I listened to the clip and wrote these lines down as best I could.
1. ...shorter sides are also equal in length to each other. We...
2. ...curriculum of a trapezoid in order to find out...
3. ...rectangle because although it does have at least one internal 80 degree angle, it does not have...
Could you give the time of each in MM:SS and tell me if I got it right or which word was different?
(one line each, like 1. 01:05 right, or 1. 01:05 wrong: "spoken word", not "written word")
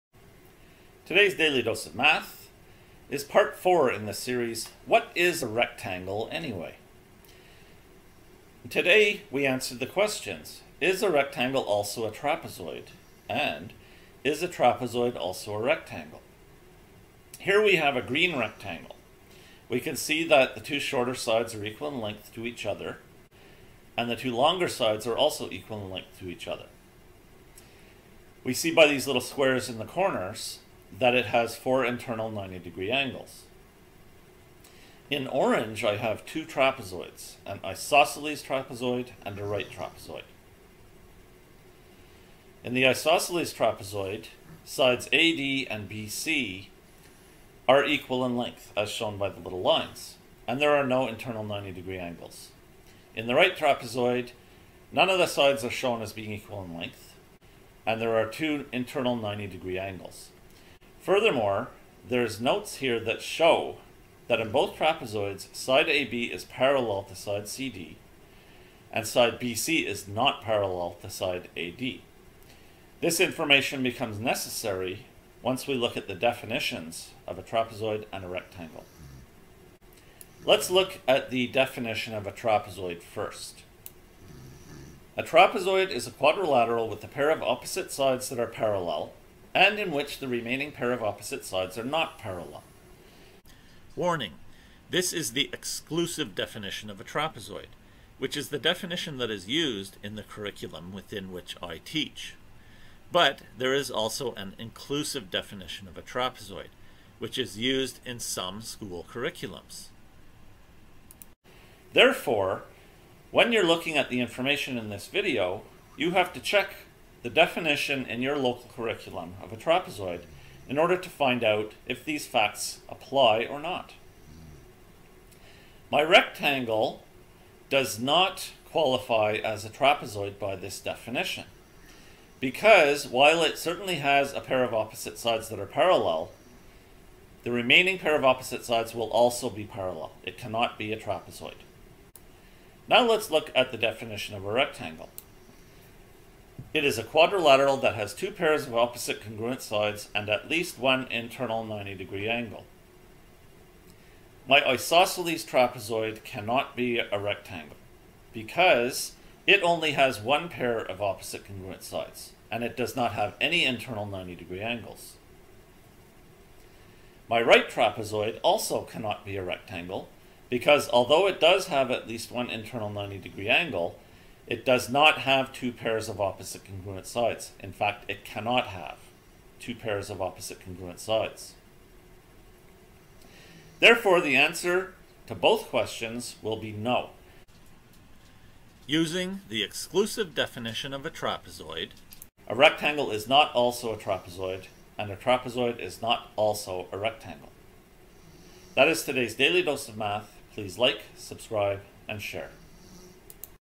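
1. 00:24 wrong: "longer", not "shorter"
2. 01:58 right
3. 02:49 wrong: "90", not "80".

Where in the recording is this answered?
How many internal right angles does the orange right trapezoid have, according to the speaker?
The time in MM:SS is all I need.
00:58.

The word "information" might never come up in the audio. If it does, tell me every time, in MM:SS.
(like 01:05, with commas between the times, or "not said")
01:13, 01:54.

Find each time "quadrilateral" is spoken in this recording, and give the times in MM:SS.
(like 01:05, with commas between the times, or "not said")
01:26, 02:27.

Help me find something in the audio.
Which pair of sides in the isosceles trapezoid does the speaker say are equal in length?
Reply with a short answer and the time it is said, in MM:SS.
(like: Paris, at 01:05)
AD and BC, at 00:44.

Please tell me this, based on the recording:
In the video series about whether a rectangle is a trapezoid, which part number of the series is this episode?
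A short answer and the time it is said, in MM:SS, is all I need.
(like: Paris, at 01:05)
4, at 00:03.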